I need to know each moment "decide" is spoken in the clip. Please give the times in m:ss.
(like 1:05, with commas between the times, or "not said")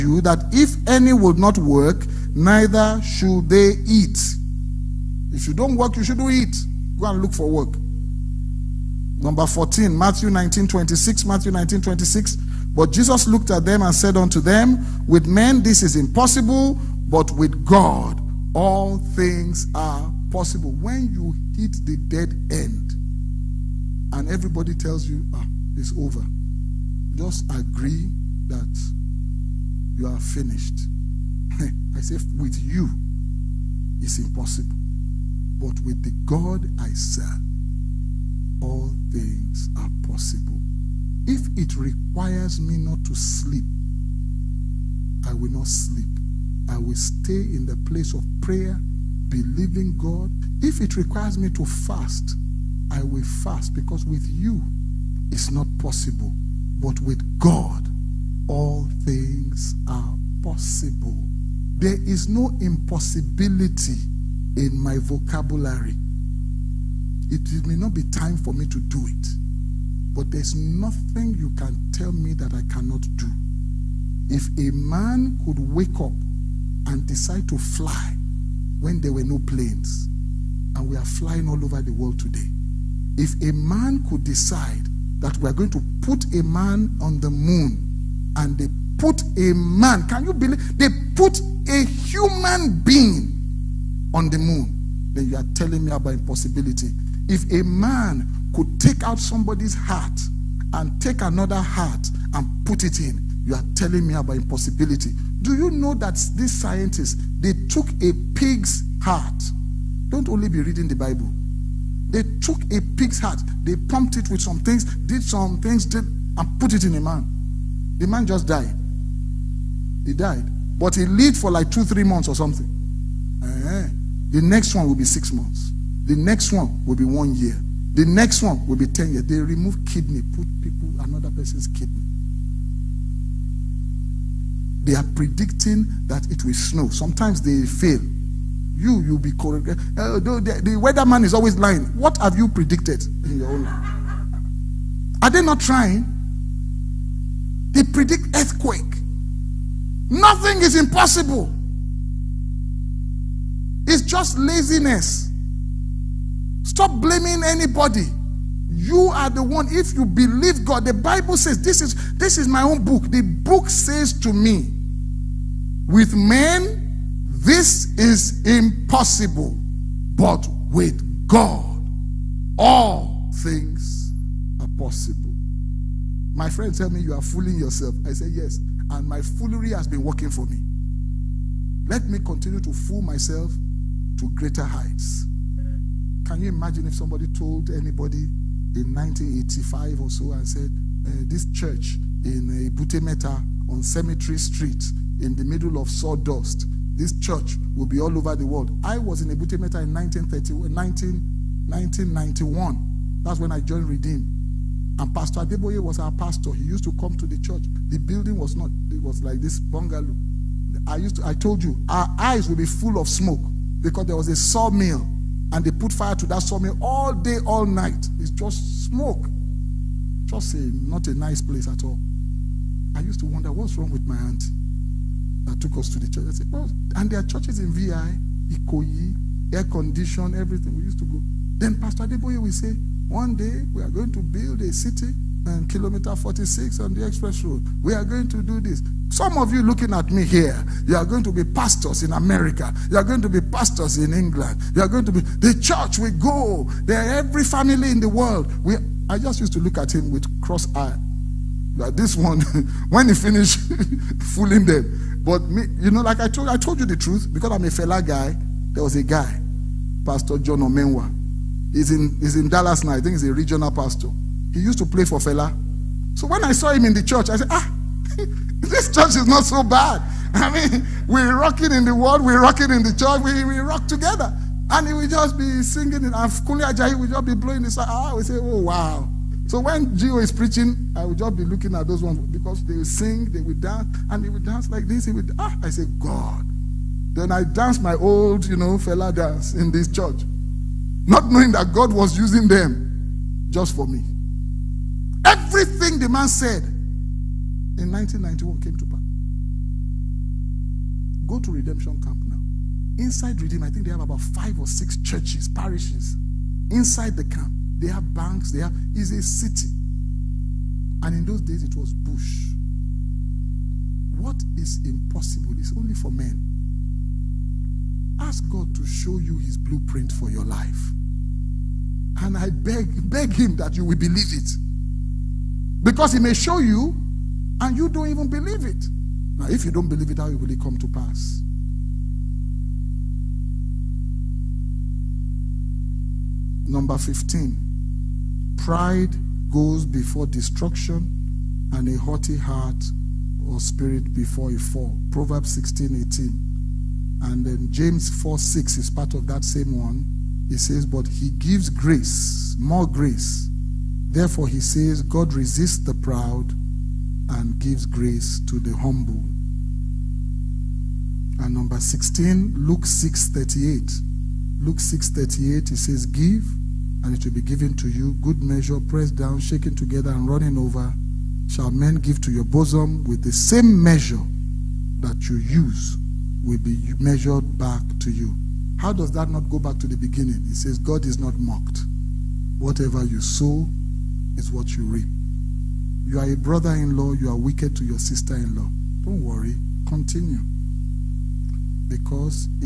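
1:17, 1:24.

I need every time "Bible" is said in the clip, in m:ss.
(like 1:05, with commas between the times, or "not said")
1:50, 2:40.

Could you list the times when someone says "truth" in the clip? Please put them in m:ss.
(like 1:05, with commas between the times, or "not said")
4:16.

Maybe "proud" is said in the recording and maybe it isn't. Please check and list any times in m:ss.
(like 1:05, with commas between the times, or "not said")
5:55.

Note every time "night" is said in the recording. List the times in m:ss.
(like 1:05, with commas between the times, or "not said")
3:37.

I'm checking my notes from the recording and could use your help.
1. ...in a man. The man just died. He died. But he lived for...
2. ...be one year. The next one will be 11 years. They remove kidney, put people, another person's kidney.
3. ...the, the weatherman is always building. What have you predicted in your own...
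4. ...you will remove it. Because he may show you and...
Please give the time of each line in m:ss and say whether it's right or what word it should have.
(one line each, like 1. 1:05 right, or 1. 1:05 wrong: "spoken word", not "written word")
1. 1:56 right
2. 2:06 wrong: "10", not "11"
3. 2:20 wrong: "lying", not "building"
4. 5:23 wrong: "believe", not "remove".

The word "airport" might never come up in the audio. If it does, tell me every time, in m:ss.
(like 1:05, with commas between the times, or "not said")
not said.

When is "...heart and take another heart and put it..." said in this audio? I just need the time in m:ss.
1:39.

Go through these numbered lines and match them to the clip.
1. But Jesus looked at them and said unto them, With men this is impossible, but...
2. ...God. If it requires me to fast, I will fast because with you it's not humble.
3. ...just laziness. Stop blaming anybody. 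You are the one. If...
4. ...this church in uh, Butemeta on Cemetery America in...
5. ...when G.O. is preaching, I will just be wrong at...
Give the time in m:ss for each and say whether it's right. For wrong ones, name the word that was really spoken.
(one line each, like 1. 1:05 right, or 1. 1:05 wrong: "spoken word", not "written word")
1. 0:12 right
2. 0:49 wrong: "possible", not "humble"
3. 2:34 right
4. 3:11 wrong: "Street", not "America"
5. 4:39 wrong: "looking", not "wrong".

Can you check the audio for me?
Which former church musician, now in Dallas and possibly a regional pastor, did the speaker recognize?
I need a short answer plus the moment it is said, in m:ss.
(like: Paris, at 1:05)
John Omenwa, at 4:20.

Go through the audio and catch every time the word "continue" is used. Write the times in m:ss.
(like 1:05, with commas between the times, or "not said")
3:02, 6:29.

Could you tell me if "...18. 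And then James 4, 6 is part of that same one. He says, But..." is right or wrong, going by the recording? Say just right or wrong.
right.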